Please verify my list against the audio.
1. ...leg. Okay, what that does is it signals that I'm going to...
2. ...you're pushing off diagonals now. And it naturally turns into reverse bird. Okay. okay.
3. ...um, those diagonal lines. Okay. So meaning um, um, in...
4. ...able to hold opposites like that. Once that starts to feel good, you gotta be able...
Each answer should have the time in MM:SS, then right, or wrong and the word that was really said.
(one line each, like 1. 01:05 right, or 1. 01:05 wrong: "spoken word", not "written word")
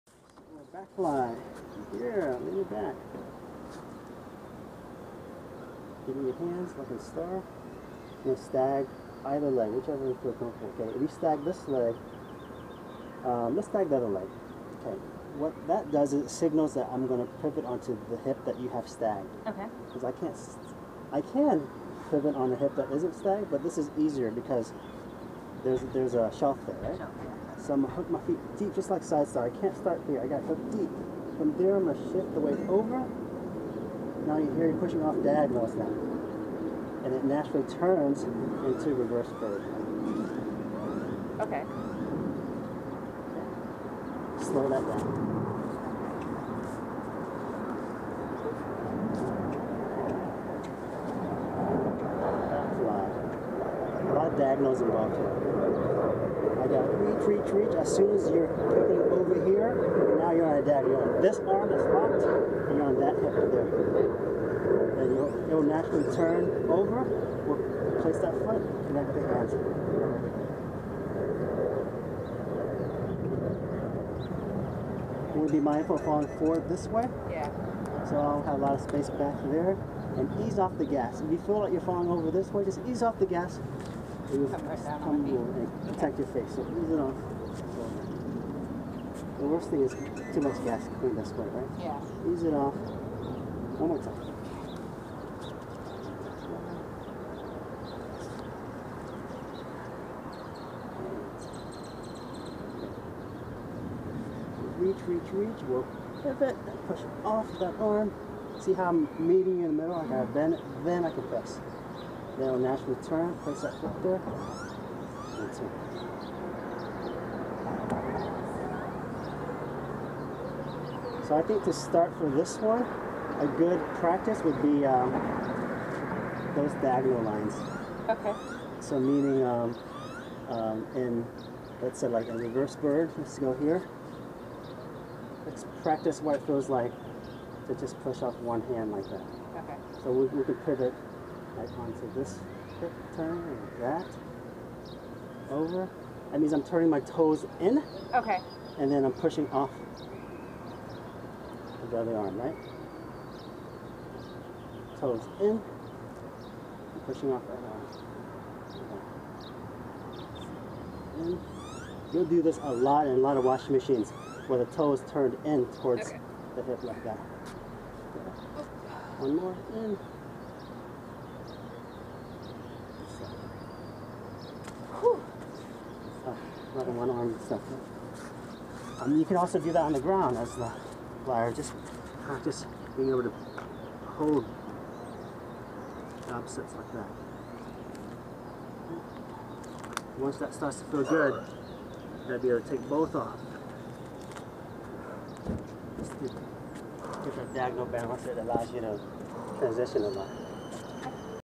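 1. 00:14 right
2. 00:34 right
3. 02:04 right
4. 03:03 right.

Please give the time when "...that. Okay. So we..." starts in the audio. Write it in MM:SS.
02:19.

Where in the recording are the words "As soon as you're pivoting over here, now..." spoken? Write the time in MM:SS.
00:57.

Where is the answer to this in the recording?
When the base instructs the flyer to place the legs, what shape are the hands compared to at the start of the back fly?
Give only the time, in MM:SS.
00:06.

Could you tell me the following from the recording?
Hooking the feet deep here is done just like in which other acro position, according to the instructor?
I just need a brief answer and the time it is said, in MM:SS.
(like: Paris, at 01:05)
side star, at 00:29.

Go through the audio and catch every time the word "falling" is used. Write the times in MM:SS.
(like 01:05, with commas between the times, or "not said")
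01:16, 01:21.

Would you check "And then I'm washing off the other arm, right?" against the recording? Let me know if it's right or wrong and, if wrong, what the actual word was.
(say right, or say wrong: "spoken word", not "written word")
wrong: "pushing", not "washing".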